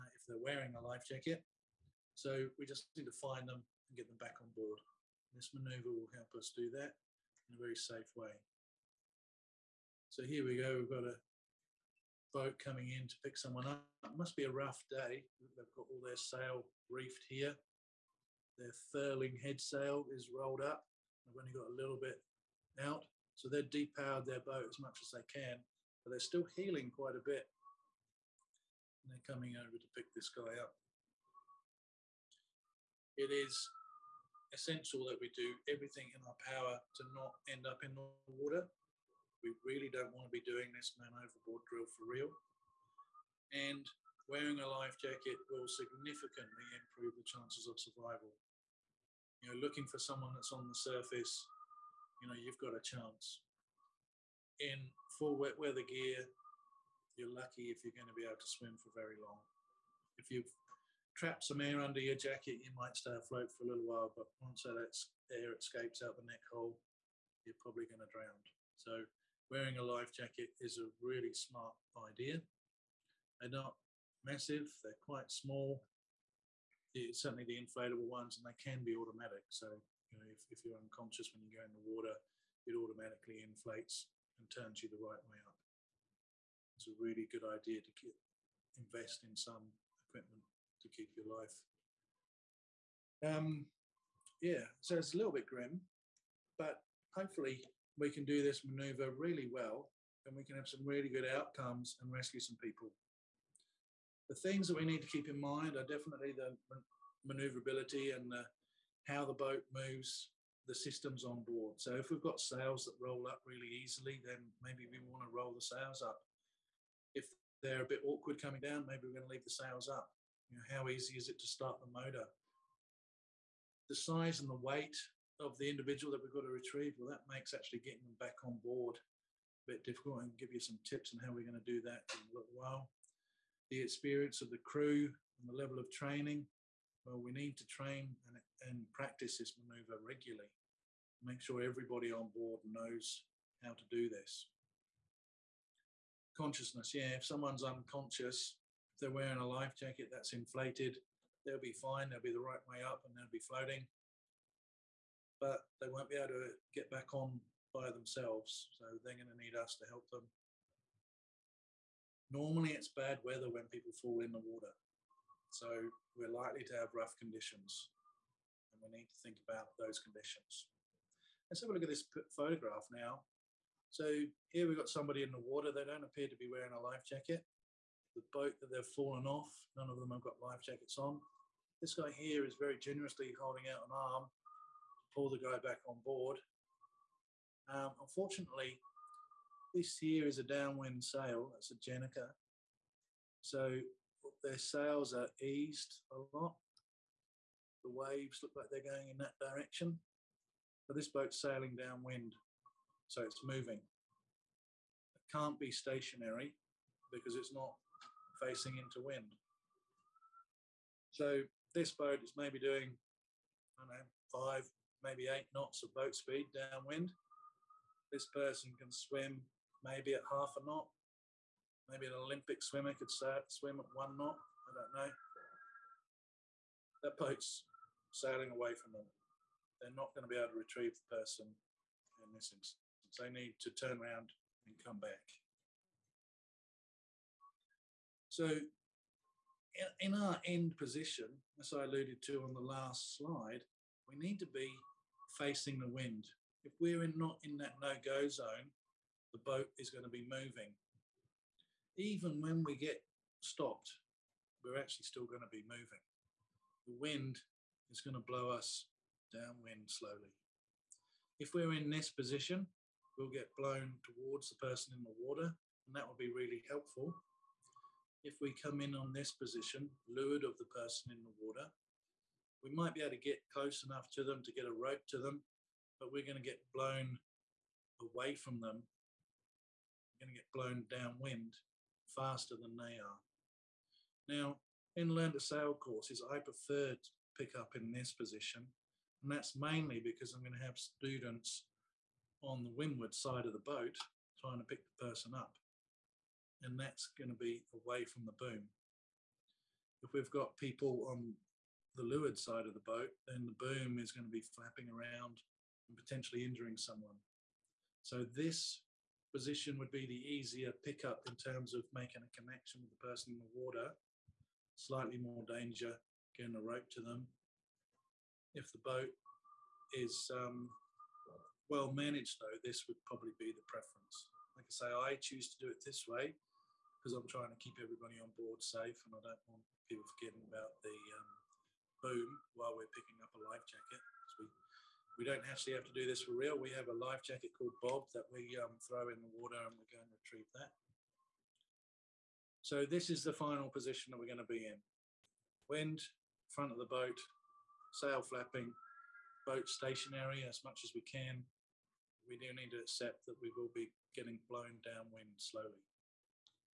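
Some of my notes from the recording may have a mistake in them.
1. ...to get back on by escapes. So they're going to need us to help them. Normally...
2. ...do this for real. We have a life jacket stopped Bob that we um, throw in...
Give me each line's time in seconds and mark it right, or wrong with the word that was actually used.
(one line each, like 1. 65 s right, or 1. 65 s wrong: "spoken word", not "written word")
1. 156 s wrong: "themselves", not "escapes"
2. 335 s wrong: "called", not "stopped".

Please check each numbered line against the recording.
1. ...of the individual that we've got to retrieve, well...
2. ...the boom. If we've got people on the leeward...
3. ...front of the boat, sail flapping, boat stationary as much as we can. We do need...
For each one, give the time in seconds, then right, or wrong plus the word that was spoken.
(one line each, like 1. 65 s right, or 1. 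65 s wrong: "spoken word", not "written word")
1. 125 s right
2. 298 s right
3. 346 s right.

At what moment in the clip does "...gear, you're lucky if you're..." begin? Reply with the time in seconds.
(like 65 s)
55 s.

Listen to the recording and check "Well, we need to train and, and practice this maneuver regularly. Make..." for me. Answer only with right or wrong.
right.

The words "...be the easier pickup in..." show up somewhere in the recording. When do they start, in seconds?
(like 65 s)
309 s.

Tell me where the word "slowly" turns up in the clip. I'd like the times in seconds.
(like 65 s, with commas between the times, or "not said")
259 s, 355 s.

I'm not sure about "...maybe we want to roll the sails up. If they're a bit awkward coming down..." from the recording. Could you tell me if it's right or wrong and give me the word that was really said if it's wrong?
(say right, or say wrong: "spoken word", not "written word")
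right.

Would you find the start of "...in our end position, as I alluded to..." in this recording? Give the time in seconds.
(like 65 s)
239 s.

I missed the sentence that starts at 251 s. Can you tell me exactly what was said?
Even when we get stopped, we're actually still going to be moving.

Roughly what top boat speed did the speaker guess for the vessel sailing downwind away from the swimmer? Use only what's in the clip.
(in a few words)
8 knots.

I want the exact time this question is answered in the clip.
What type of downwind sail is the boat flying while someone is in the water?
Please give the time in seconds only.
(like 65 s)
191 s.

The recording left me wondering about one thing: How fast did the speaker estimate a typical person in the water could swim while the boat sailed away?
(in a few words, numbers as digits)
half a knot.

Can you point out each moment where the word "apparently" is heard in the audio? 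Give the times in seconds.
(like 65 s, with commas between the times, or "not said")
not said.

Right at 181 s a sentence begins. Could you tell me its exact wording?
This guy here is very generously holding out an arm to pull the guy back on board.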